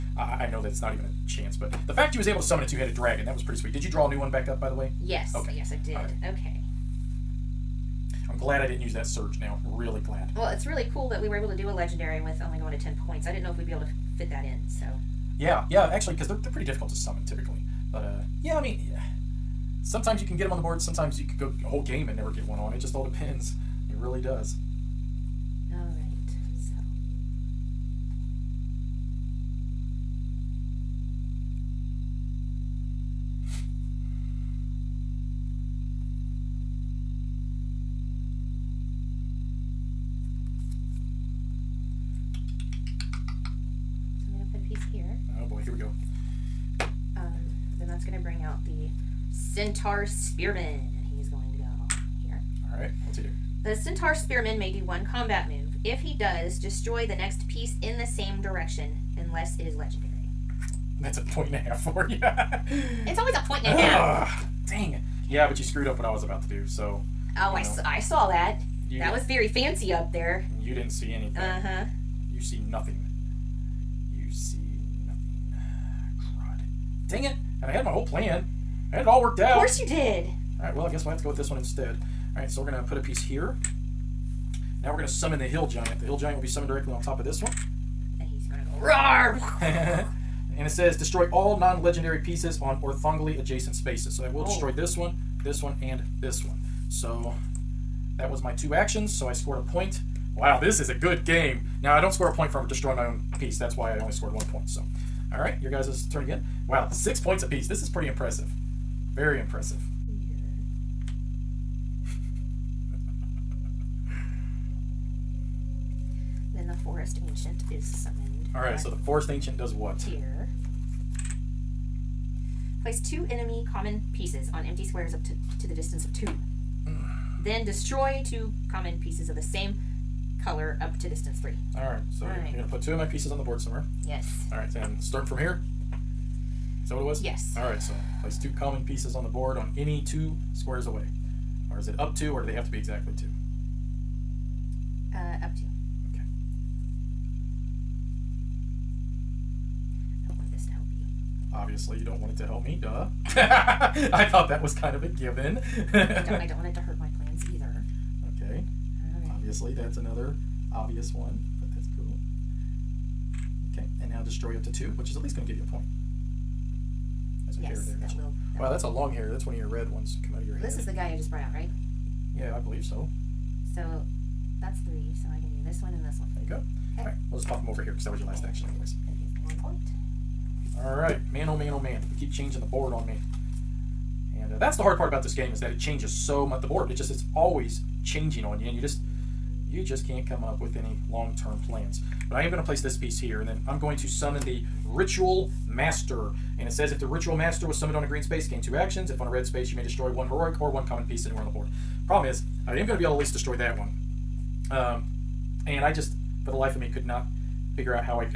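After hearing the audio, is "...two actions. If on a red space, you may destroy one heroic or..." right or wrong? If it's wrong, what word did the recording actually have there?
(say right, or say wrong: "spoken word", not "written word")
right.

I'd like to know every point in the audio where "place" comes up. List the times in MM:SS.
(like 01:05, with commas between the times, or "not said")
02:02, 02:18, 03:12.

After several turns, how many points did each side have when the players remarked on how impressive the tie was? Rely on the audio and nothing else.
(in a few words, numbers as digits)
6.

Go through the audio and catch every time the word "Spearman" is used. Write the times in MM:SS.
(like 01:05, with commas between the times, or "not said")
00:50, 00:54.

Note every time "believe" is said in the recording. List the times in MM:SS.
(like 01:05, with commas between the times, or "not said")
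02:52.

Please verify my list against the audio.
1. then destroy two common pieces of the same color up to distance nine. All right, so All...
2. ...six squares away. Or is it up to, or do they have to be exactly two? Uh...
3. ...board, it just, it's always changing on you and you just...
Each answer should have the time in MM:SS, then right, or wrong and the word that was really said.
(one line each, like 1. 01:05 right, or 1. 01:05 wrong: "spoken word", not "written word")
1. 02:07 wrong: "three", not "nine"
2. 02:20 wrong: "two", not "six"
3. 03:06 right.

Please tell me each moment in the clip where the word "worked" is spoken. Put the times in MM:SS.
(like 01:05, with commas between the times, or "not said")
01:19.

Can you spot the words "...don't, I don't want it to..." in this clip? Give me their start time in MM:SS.
02:36.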